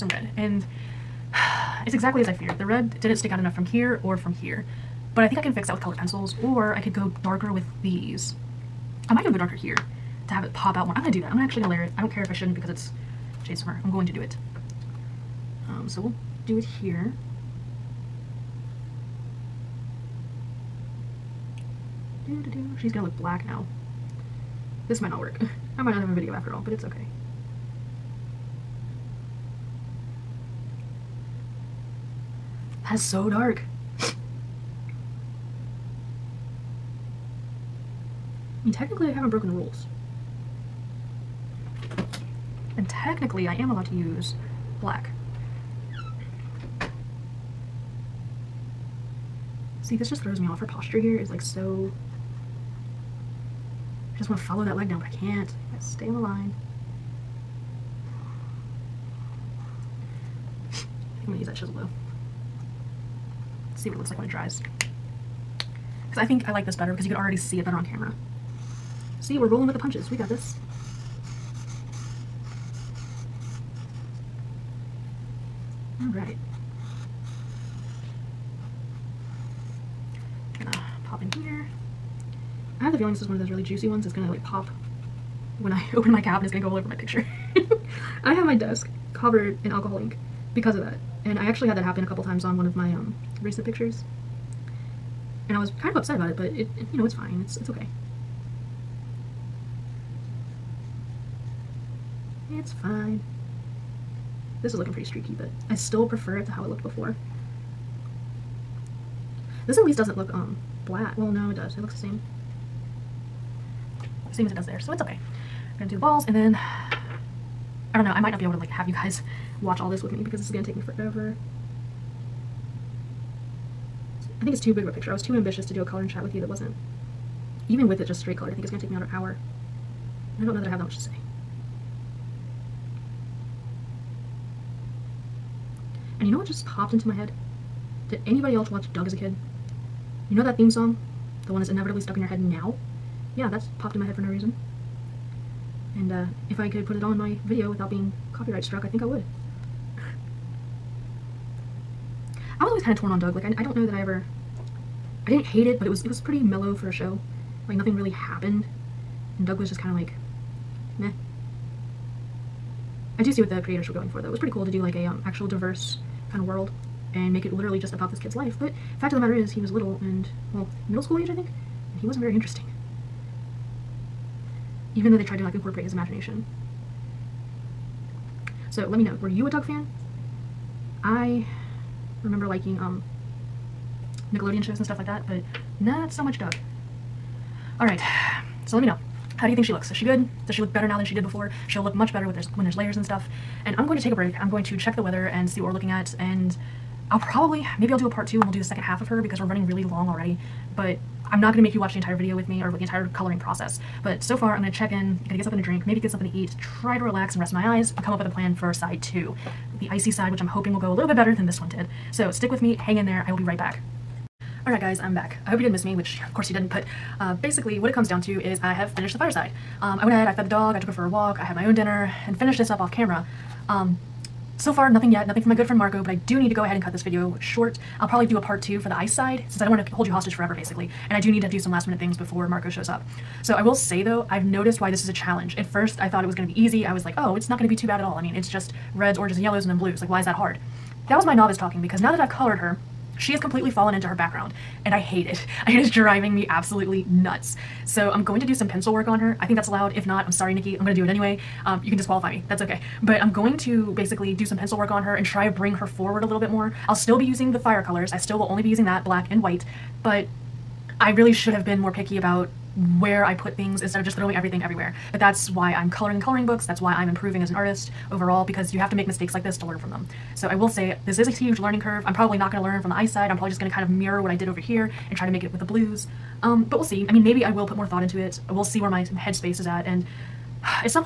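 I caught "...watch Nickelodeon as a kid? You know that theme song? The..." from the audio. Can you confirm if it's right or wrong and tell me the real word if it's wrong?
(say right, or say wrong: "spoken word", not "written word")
wrong: "Doug", not "Nickelodeon".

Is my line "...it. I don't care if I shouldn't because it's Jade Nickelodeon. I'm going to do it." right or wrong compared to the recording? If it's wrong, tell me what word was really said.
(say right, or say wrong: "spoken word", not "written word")
wrong: "Summer", not "Nickelodeon".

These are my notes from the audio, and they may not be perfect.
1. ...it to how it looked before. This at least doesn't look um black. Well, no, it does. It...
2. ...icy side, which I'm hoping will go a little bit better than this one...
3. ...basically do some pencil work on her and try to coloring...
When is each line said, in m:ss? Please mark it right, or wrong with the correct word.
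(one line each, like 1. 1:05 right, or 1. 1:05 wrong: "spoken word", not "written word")
1. 1:46 right
2. 3:29 right
3. 4:13 wrong: "bring", not "coloring".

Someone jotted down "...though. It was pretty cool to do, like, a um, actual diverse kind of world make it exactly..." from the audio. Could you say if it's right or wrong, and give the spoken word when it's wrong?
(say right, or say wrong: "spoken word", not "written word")
wrong: "literally", not "exactly".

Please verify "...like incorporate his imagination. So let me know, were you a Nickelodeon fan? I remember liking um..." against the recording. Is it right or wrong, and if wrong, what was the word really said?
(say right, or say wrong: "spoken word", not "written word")
wrong: "Doug", not "Nickelodeon".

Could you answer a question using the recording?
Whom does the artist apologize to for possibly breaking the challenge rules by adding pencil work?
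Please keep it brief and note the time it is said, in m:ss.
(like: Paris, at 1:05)
Nikki, at 4:10.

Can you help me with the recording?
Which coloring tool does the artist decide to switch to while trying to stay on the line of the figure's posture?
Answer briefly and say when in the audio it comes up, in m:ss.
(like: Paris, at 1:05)
chisel, at 1:01.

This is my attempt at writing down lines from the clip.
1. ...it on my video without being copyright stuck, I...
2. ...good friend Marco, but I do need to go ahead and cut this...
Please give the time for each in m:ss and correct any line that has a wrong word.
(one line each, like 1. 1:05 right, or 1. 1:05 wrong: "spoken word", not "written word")
1. 2:26 wrong: "struck", not "stuck"
2. 3:45 right.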